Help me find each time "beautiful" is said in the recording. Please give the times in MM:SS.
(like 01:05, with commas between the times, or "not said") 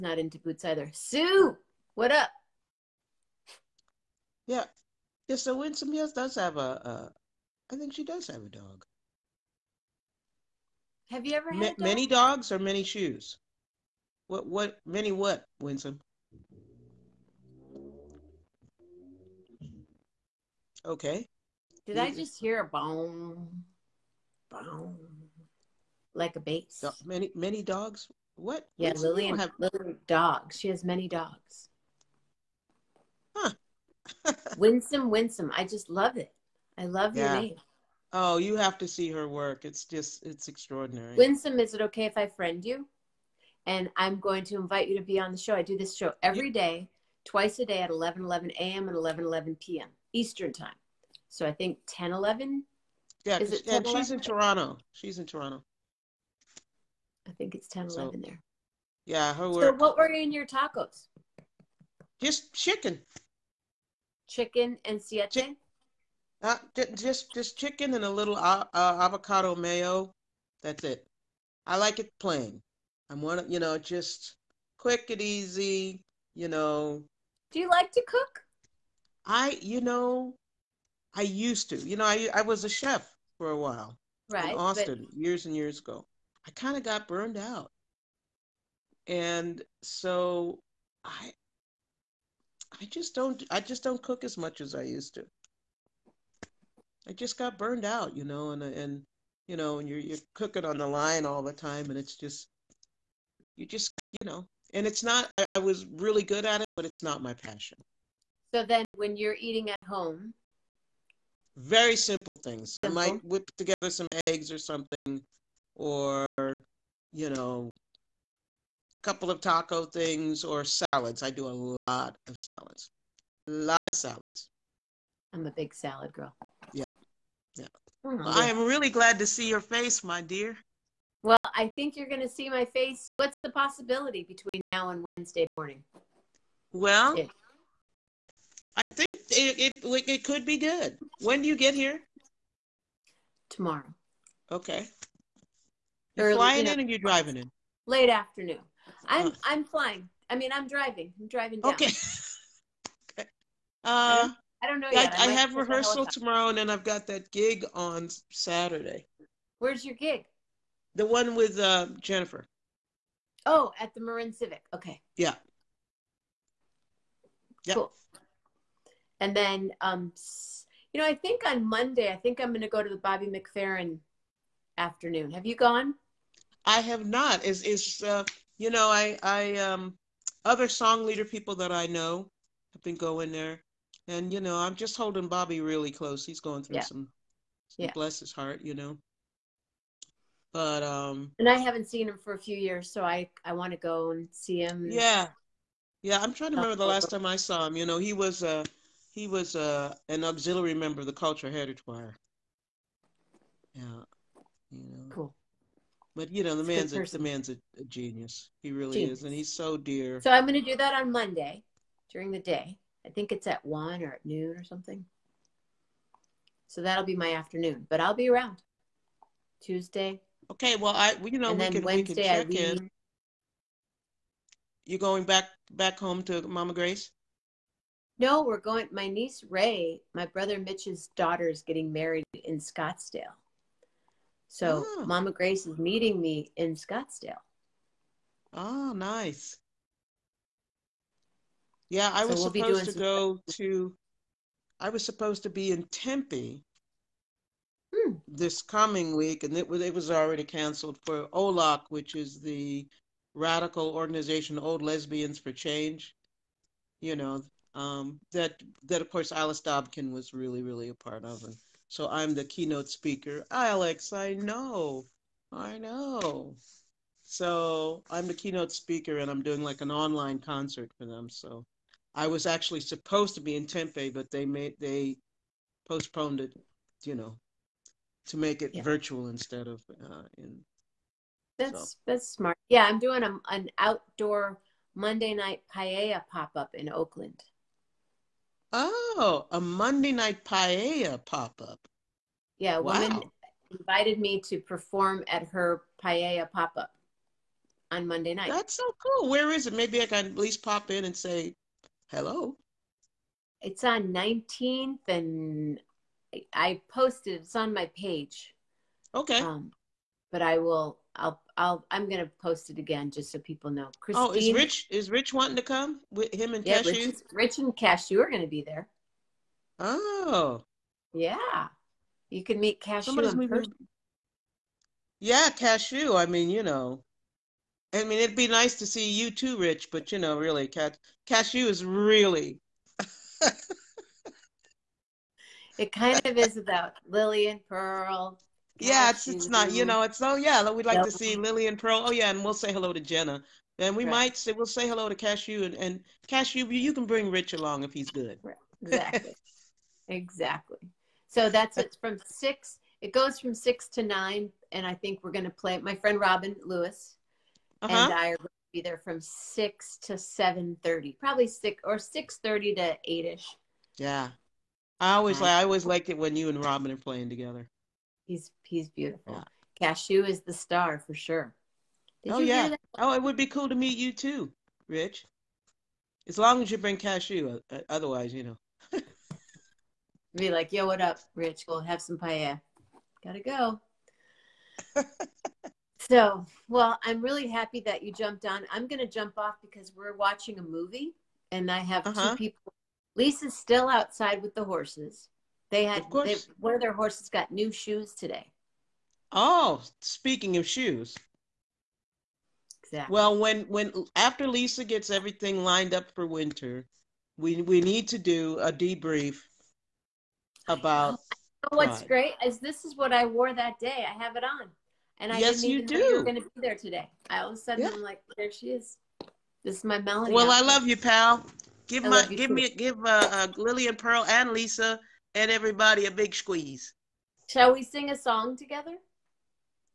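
06:08.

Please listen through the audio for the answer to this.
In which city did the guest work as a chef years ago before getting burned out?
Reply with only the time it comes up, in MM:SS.
01:24.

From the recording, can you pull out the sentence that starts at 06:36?
They, one of their horses got new shoes today.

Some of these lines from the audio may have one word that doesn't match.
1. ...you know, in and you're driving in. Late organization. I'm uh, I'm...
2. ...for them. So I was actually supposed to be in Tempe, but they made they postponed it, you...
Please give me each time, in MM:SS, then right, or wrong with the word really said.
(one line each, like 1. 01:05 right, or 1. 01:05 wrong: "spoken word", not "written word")
1. 02:26 wrong: "afternoon", not "organization"
2. 04:30 right.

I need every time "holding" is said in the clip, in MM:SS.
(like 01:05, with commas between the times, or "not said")
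03:04.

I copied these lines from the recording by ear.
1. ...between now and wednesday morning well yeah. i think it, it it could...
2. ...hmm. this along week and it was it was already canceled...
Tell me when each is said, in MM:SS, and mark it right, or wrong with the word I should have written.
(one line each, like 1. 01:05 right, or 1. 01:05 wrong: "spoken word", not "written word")
1. 02:14 right
2. 04:07 wrong: "coming", not "along".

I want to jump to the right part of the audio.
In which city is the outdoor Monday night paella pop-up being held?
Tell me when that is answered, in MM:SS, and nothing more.
04:46.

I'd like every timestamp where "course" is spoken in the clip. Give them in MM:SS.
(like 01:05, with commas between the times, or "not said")
04:19, 06:36.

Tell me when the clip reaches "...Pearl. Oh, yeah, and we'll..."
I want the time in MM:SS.
05:41.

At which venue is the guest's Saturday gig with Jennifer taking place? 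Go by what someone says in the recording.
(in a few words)
Marin Civic.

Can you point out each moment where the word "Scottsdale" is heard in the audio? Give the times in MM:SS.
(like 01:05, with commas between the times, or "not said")
03:52, 03:56.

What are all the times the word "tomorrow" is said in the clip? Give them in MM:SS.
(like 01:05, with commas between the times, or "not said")
02:23, 02:36.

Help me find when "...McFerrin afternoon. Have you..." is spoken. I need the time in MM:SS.
02:53.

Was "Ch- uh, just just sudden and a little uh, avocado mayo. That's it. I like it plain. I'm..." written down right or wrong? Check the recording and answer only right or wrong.
wrong.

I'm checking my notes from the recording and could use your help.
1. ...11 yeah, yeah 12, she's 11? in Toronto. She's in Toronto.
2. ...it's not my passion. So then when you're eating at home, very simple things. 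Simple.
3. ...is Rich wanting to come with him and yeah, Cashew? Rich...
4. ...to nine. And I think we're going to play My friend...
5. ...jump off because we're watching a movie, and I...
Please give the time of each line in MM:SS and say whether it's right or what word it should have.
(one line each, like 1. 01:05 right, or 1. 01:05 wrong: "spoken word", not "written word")
1. 00:52 wrong: "10", not "12"
2. 01:46 right
3. 05:14 right
4. 05:53 right
5. 06:29 right.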